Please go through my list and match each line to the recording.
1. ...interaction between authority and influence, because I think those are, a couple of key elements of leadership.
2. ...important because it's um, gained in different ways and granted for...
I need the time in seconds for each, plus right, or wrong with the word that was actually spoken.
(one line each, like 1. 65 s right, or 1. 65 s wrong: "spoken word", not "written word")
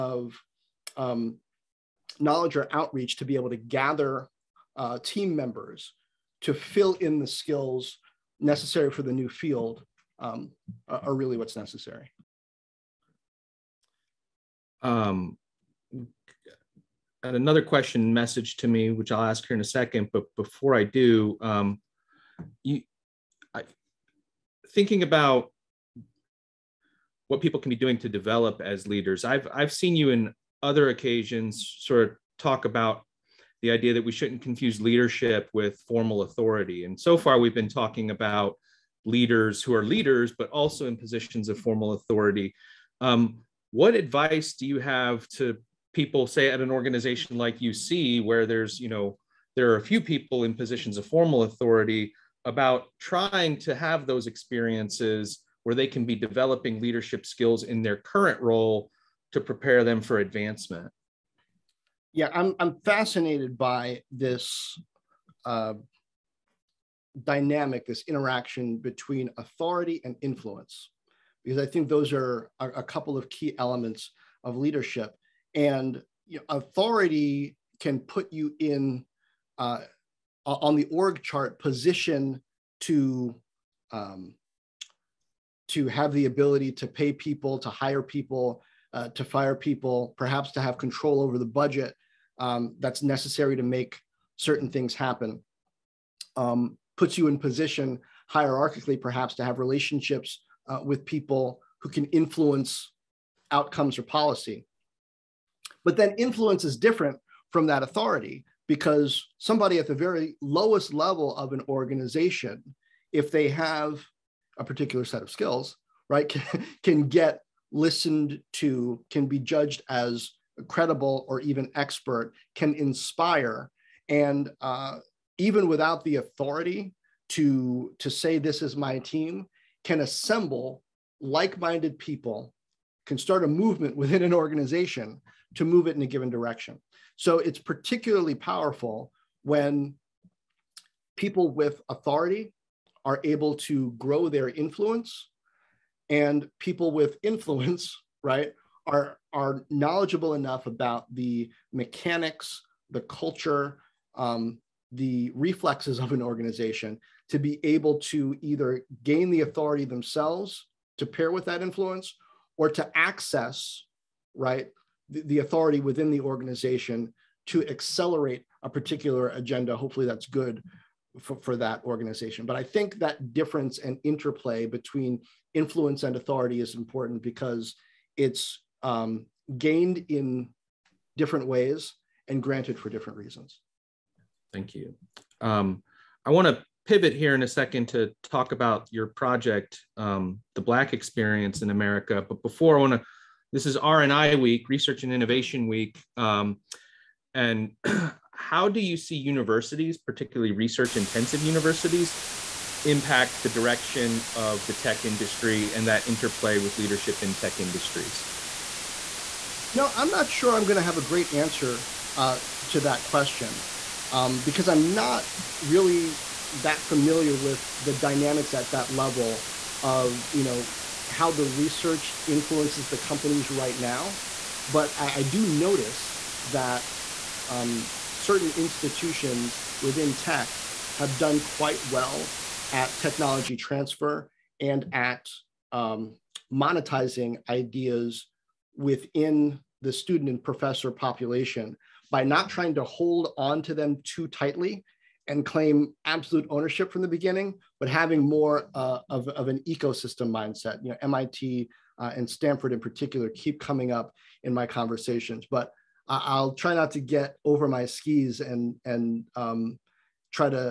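1. 68 s right
2. 176 s right.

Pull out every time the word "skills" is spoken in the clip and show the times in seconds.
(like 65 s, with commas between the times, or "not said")
7 s, 57 s, 115 s.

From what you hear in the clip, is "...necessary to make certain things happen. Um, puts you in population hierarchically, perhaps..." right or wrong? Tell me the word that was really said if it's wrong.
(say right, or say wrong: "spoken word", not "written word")
wrong: "position", not "population".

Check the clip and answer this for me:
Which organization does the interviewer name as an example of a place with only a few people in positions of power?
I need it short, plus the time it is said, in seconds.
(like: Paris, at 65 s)
UC, at 47 s.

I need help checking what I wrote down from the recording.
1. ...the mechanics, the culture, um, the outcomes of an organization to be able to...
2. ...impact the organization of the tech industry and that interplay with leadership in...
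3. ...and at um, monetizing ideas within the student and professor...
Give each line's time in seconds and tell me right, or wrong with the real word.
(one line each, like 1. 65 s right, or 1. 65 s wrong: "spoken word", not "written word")
1. 151 s wrong: "reflexes", not "outcomes"
2. 202 s wrong: "direction", not "organization"
3. 234 s right.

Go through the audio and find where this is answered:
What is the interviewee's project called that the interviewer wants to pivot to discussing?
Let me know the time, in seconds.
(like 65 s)
190 s.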